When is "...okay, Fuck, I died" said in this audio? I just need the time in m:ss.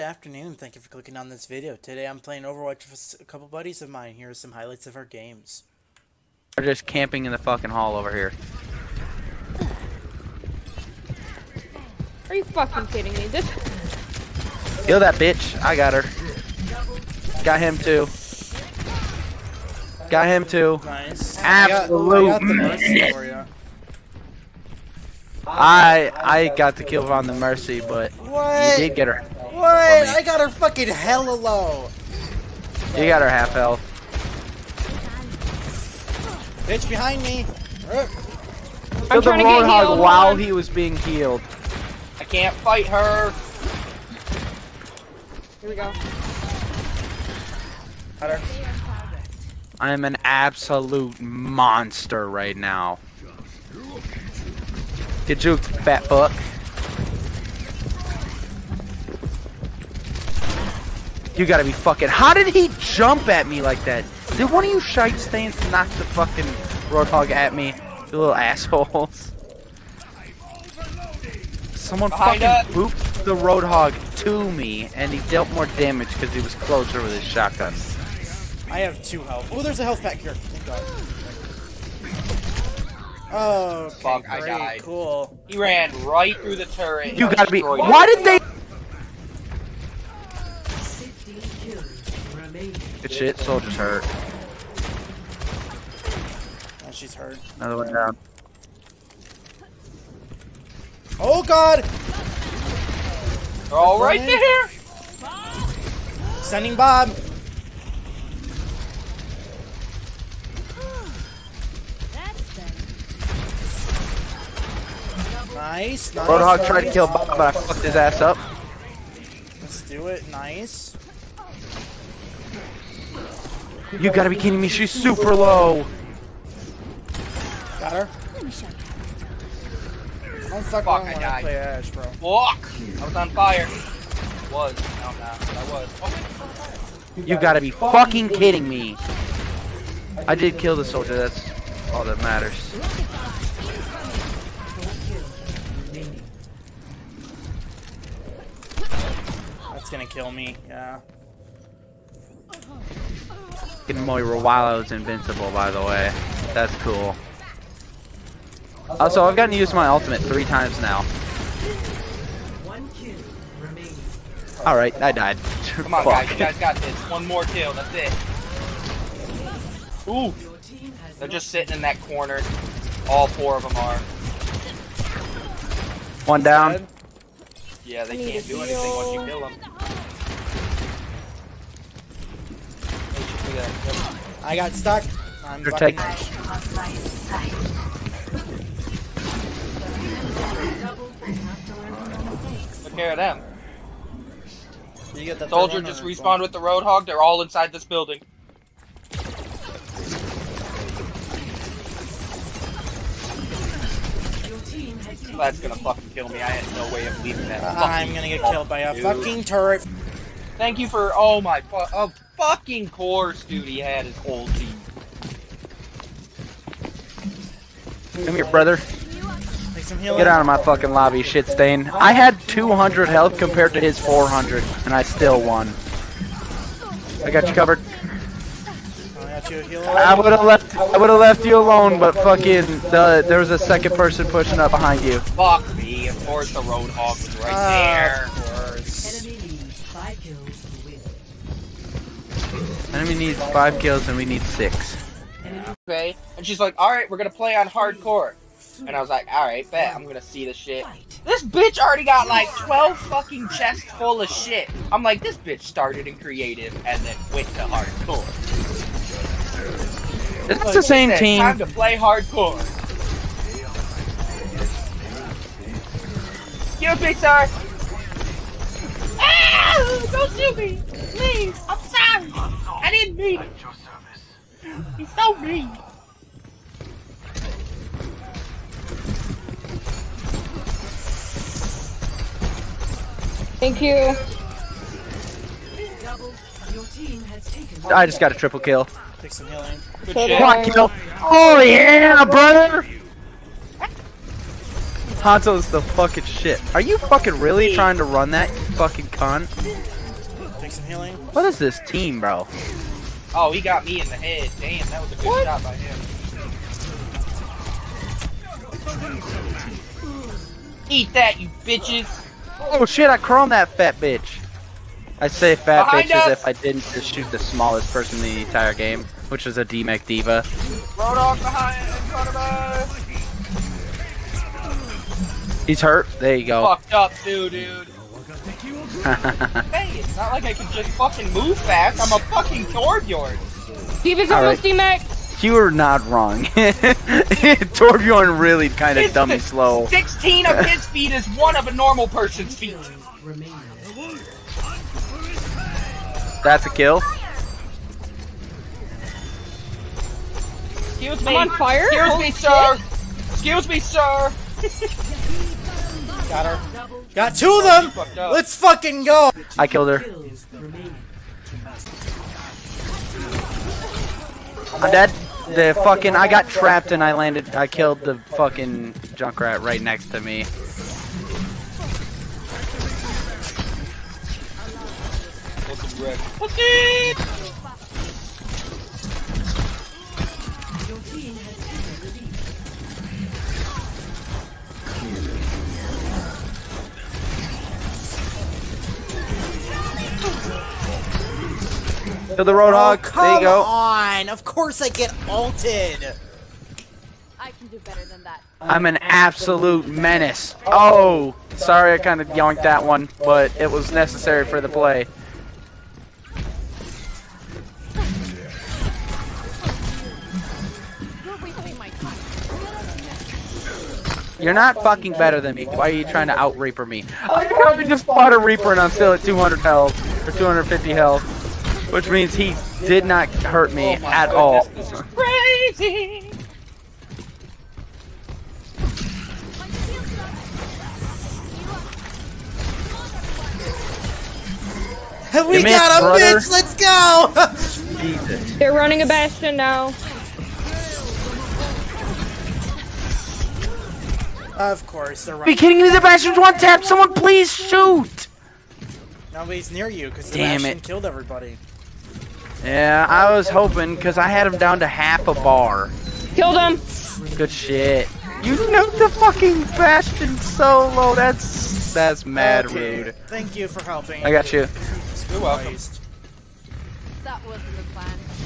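1:23.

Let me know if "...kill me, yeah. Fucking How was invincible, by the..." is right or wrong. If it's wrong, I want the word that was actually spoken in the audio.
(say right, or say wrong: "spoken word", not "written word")
wrong: "Moira", not "How".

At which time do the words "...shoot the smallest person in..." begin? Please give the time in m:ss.
5:17.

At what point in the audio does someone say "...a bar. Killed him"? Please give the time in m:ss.
7:35.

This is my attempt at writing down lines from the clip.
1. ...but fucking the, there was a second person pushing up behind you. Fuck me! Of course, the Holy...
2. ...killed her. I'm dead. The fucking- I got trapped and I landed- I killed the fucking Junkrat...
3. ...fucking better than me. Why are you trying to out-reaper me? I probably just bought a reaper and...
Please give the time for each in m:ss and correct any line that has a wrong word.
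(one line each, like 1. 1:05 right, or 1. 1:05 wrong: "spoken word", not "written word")
1. 3:51 wrong: "Roadhog", not "Holy"
2. 5:59 right
3. 6:54 right.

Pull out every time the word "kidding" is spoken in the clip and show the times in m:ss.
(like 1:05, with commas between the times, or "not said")
0:12, 2:04, 2:18, 7:25.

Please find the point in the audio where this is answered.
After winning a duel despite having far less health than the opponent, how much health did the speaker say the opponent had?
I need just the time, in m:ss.
3:43.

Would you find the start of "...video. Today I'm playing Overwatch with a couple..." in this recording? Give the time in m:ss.
0:01.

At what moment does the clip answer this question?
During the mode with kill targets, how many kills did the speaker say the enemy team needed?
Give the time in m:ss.
4:03.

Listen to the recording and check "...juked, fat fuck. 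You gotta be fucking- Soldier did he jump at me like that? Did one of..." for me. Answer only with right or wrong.
wrong.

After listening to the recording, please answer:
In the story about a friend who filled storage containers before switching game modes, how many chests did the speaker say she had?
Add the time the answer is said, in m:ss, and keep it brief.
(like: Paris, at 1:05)
12, at 4:12.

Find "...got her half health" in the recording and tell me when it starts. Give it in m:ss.
0:33.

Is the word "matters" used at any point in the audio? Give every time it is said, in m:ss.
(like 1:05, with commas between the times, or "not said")
2:22.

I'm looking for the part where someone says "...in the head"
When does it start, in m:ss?
5:04.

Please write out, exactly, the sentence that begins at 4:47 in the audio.
I just got a triple kill.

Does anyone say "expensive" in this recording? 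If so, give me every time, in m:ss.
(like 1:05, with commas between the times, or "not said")
not said.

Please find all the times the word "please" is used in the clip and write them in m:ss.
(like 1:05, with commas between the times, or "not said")
4:30, 7:27.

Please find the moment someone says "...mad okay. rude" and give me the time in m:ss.
7:42.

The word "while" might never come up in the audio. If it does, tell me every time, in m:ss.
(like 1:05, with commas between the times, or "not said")
0:39.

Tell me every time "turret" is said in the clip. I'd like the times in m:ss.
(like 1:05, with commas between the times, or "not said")
1:26, 3:29.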